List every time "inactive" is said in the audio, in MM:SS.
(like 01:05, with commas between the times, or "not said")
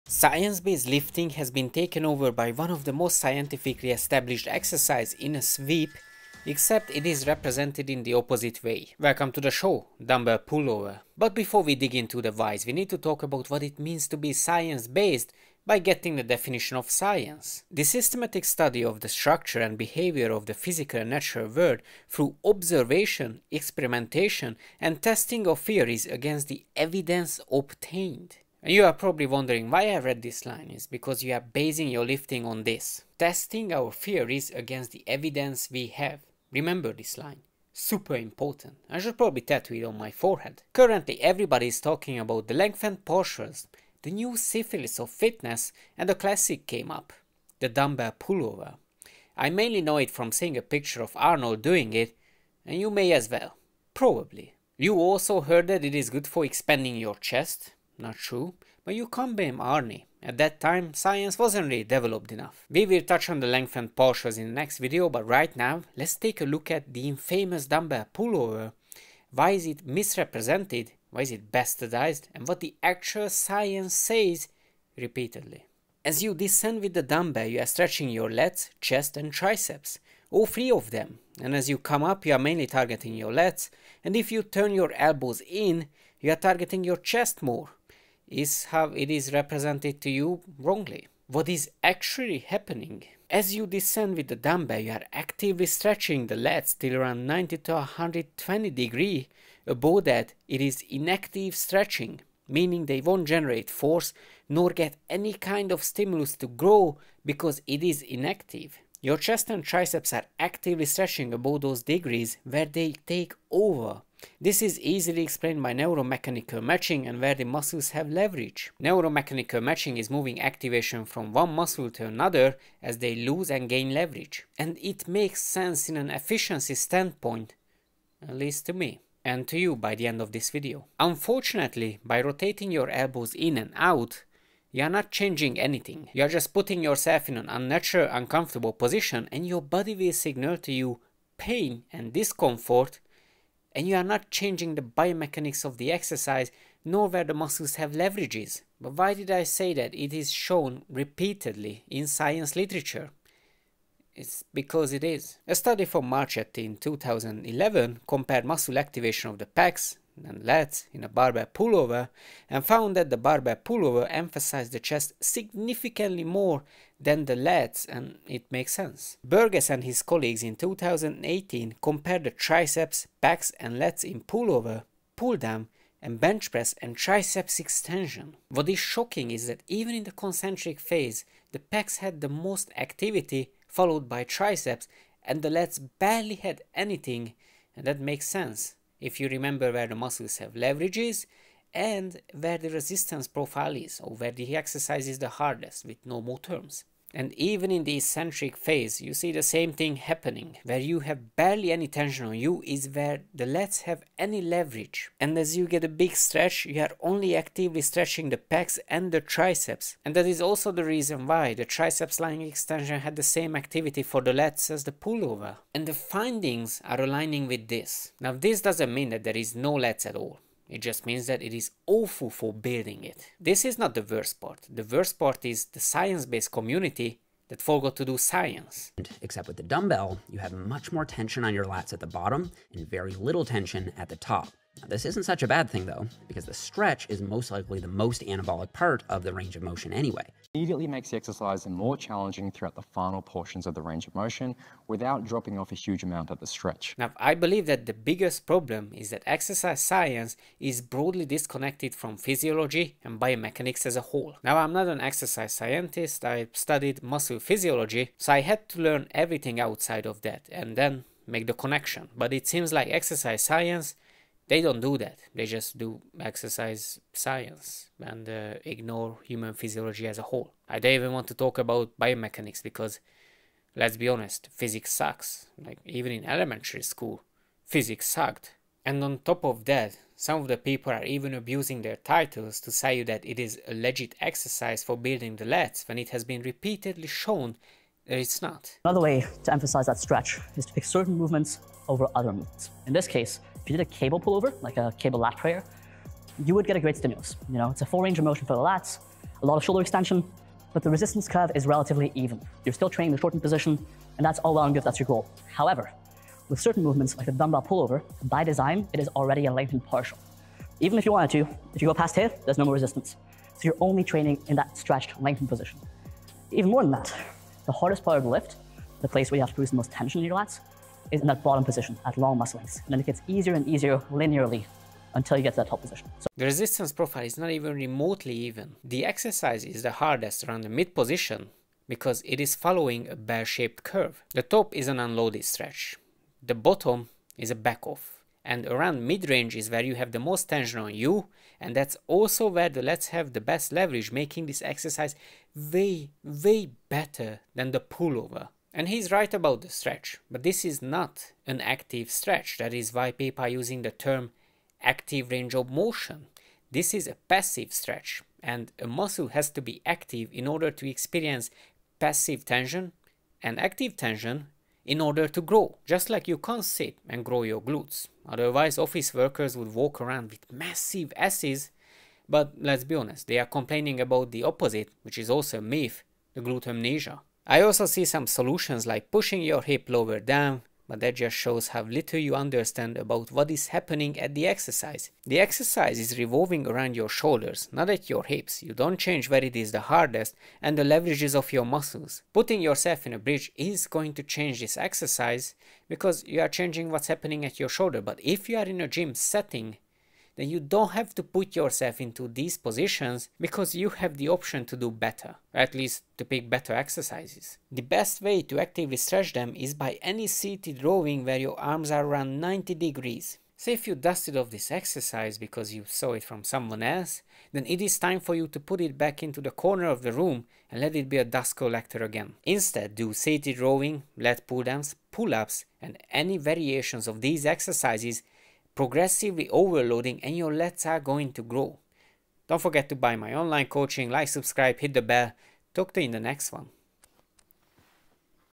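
01:40, 01:48.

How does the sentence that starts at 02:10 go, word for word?
Unfortunately, by rotating your elbows in and out, you're not changing anything.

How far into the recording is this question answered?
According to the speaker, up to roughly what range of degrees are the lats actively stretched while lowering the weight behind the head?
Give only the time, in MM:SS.
01:37.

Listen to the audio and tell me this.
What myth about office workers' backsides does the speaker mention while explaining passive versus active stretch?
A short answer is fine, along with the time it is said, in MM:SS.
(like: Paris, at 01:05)
Glute amnesia, at 06:16.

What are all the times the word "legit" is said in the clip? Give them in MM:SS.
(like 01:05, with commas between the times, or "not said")
04:43.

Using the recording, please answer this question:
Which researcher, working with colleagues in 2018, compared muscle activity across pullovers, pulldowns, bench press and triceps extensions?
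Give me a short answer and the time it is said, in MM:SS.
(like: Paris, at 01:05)
Burgess, at 02:49.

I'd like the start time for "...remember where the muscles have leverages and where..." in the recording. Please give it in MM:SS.
03:09.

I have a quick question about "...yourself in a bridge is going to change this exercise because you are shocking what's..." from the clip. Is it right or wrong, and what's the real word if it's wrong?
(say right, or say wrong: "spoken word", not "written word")
wrong: "changing", not "shocking".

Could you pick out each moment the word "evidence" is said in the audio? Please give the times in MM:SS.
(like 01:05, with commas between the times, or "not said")
00:26, 00:35.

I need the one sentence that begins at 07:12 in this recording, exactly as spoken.
Don't forget to buy my online coaching, like, subscribe, hit the bell.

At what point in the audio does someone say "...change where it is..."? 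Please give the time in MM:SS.
06:28.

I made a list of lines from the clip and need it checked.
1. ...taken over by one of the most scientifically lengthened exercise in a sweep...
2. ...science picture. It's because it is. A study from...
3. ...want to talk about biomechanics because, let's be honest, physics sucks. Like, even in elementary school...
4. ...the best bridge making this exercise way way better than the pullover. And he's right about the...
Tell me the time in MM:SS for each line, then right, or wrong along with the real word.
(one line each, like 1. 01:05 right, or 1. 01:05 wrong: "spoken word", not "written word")
1. 00:01 wrong: "established", not "lengthened"
2. 02:32 wrong: "literature", not "picture"
3. 04:31 right
4. 05:43 wrong: "leverage", not "bridge".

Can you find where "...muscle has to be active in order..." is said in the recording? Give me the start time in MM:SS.
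05:58.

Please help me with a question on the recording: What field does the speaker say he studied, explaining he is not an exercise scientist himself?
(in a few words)
Muscle physiology.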